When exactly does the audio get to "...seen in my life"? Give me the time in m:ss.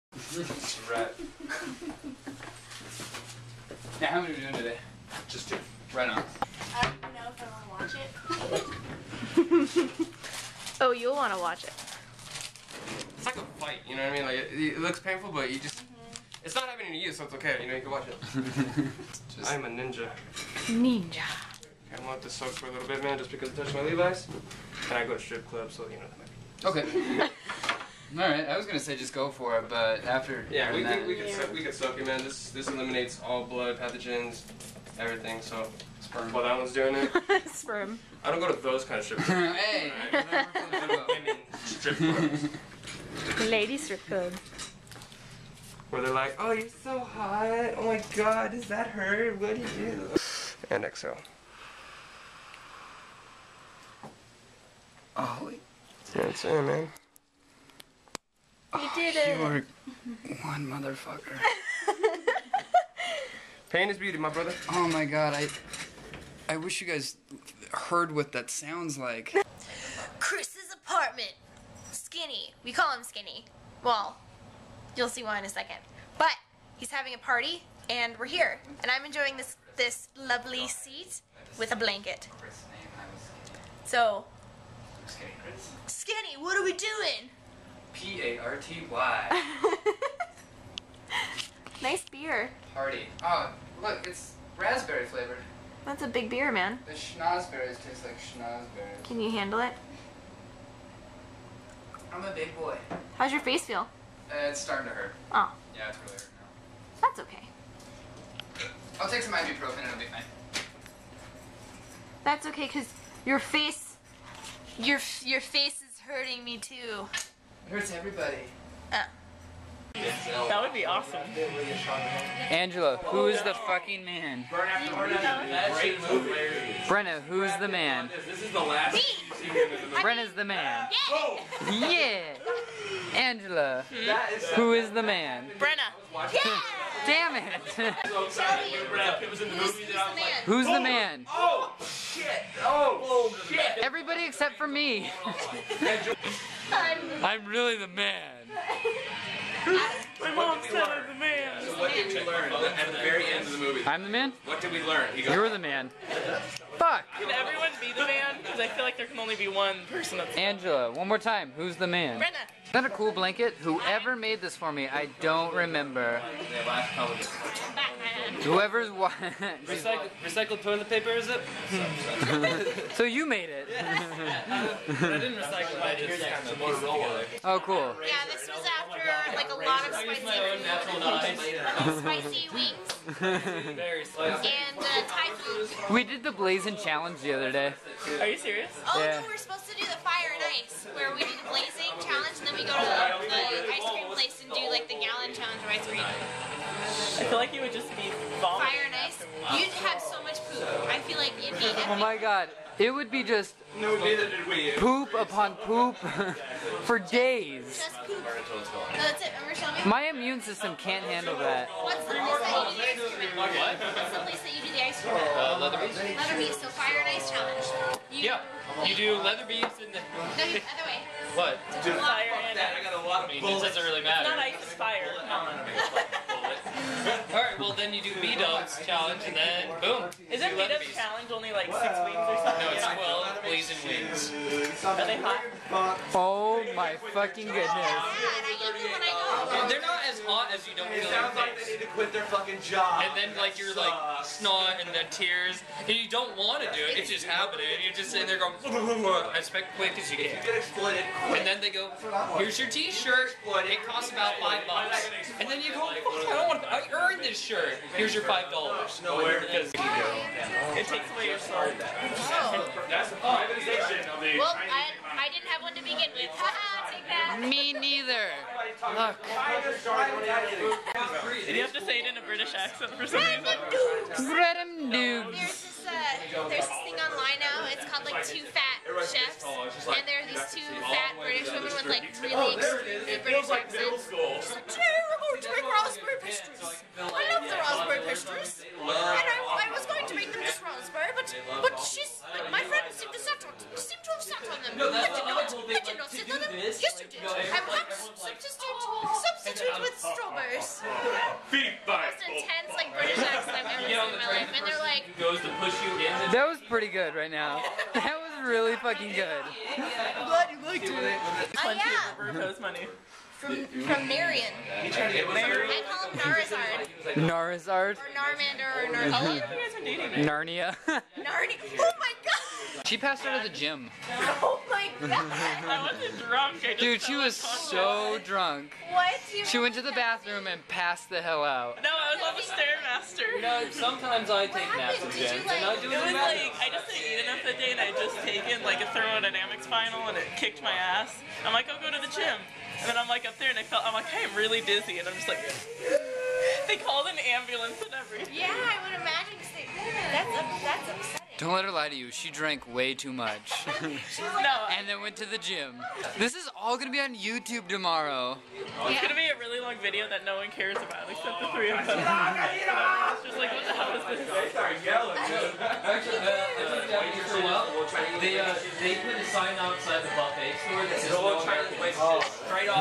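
5:03.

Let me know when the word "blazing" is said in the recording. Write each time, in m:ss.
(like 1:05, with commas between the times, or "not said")
3:06, 3:11, 3:53.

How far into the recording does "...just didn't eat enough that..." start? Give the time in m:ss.
5:36.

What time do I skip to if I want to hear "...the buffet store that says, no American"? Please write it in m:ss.
6:10.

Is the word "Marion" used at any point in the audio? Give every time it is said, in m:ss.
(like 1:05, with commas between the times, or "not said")
5:14.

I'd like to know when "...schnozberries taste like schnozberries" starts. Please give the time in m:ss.
1:36.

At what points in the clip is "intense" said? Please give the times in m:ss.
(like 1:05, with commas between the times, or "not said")
5:02.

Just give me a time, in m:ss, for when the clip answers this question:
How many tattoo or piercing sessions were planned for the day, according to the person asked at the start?
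0:05.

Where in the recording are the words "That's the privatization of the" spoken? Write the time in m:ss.
4:22.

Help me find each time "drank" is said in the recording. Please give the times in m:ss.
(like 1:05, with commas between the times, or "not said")
5:52.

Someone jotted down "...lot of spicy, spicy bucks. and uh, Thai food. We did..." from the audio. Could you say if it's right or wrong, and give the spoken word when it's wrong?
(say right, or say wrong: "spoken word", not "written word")
wrong: "weeks", not "bucks".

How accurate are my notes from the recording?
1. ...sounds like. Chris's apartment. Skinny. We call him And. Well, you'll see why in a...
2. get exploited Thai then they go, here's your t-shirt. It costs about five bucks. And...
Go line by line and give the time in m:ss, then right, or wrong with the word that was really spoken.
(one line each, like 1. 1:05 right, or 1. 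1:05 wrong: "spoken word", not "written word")
1. 1:08 wrong: "Skinny", not "And"
2. 4:10 wrong: "And", not "Thai".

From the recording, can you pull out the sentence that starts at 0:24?
And I go to strip club, so, you know, that might be...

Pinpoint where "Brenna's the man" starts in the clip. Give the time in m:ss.
2:09.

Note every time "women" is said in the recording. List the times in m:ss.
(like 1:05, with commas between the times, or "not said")
0:40, 4:41.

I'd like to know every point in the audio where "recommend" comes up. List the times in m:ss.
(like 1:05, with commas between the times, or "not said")
not said.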